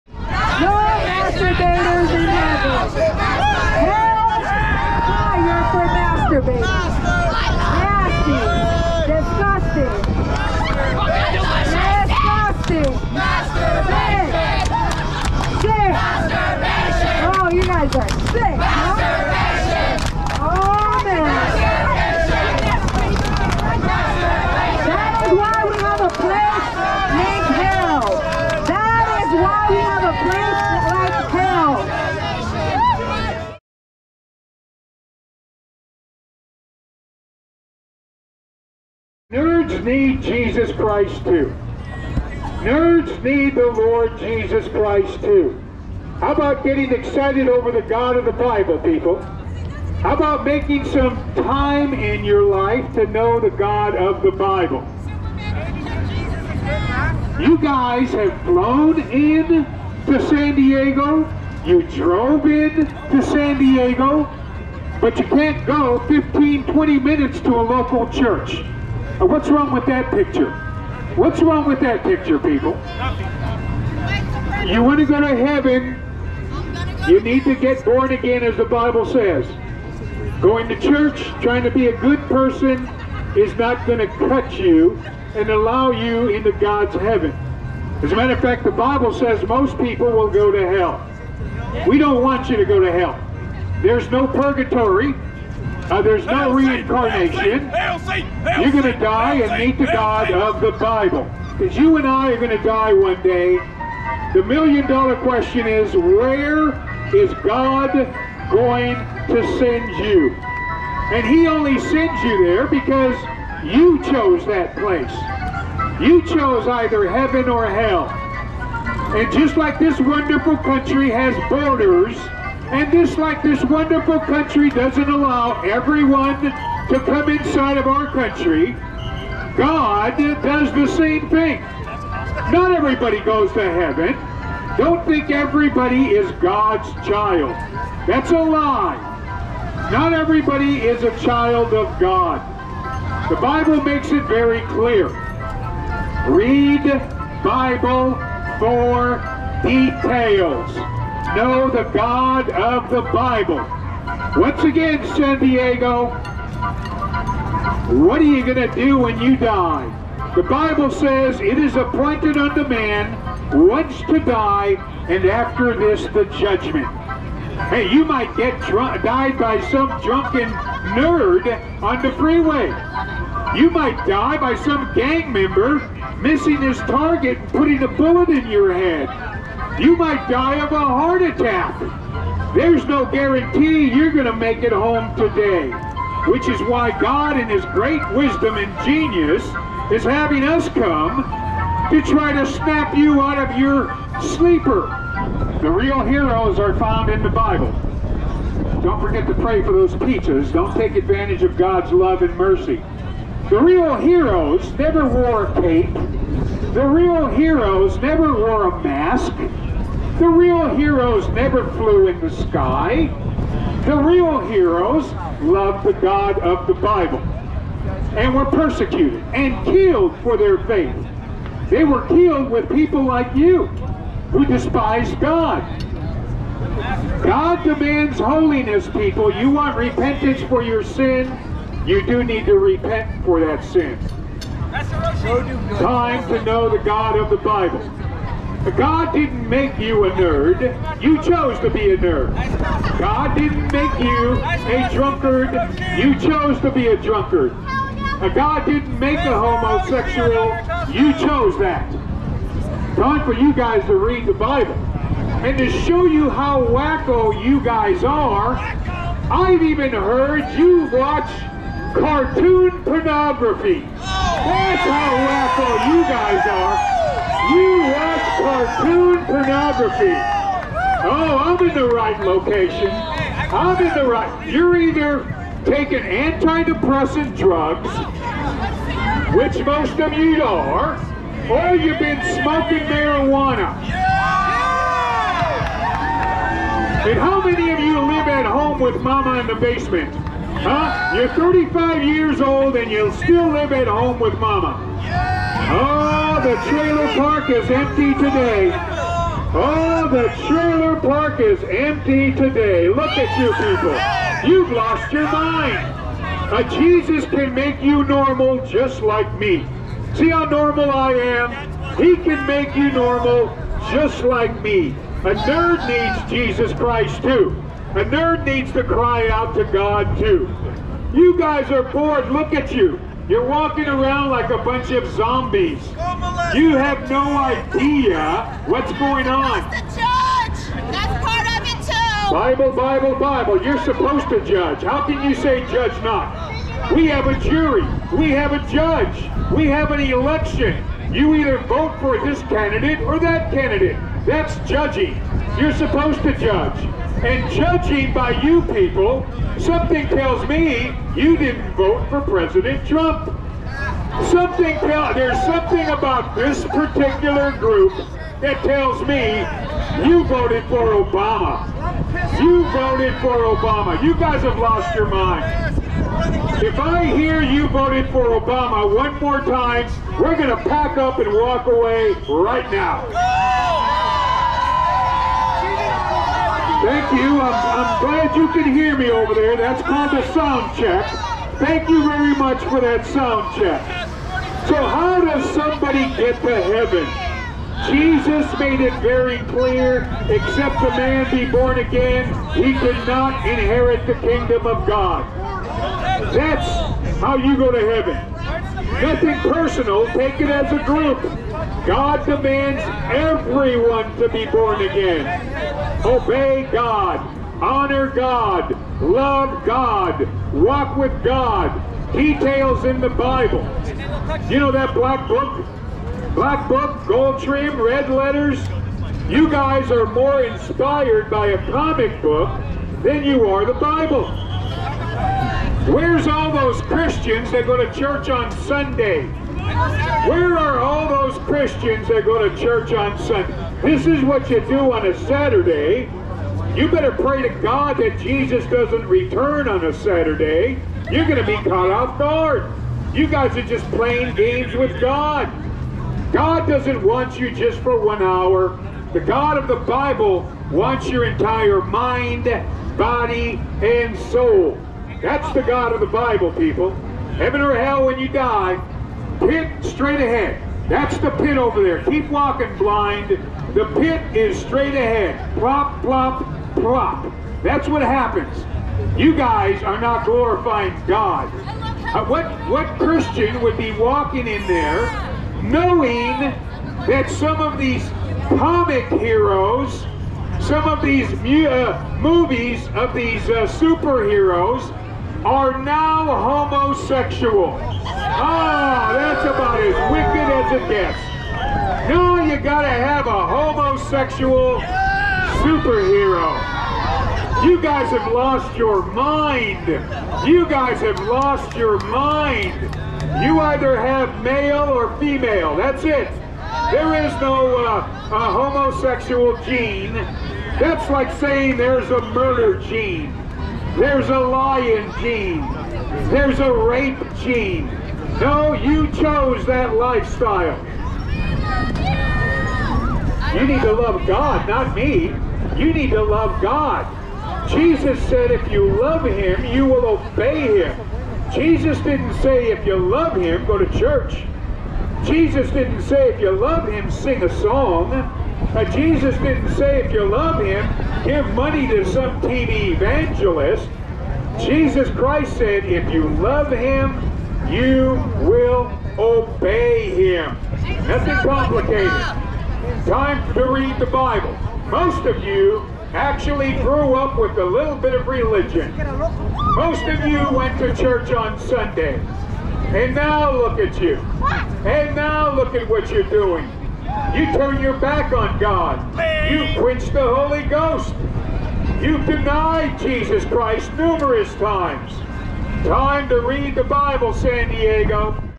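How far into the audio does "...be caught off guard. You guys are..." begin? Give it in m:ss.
7:21.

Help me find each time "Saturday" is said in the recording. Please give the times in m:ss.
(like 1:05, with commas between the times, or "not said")
7:15, 7:19.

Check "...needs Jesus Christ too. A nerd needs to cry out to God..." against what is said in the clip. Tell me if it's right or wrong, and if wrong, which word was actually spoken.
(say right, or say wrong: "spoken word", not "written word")
right.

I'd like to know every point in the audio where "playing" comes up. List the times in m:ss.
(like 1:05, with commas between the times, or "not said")
7:23.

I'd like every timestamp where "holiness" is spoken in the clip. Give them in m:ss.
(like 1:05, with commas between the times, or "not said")
3:48.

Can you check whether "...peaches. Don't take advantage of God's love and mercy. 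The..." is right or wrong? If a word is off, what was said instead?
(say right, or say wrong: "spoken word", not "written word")
right.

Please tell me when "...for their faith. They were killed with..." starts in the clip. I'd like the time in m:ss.
3:40.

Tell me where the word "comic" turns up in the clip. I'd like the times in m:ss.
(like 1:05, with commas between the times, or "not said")
7:01, 7:58.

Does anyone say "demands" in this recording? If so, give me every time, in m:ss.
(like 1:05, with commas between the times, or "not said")
3:47, 6:42.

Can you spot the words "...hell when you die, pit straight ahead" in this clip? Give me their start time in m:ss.
7:37.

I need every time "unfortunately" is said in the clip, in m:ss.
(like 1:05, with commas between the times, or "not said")
not said.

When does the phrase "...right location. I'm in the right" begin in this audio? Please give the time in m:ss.
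4:31.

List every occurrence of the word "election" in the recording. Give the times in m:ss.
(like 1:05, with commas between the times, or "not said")
5:40.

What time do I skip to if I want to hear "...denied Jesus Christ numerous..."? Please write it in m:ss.
9:32.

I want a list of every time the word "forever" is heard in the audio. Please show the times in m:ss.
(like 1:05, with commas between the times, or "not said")
not said.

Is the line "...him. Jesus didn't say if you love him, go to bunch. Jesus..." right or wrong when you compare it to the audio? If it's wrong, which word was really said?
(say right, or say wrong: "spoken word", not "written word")
wrong: "church", not "bunch".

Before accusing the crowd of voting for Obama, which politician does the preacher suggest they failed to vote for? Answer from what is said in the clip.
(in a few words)
President Trump.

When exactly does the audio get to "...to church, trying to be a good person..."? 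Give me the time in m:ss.
1:20.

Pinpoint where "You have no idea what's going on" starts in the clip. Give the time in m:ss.
5:26.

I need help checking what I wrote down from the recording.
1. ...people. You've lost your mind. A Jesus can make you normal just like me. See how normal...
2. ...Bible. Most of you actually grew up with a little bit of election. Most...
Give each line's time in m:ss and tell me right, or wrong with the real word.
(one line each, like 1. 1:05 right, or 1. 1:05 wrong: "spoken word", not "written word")
1. 5:03 right
2. 9:14 wrong: "religion", not "election".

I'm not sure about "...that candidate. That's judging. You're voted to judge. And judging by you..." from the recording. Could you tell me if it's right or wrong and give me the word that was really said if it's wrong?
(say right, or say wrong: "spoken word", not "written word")
wrong: "supposed", not "voted".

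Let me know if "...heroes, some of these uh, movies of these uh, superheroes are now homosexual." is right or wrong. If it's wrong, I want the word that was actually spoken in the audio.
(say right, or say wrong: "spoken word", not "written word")
right.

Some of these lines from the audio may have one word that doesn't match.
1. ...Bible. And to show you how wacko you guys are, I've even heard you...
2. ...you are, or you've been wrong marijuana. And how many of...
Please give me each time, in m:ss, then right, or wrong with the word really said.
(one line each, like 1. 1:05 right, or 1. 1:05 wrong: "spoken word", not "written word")
1. 4:14 right
2. 4:40 wrong: "smoking", not "wrong".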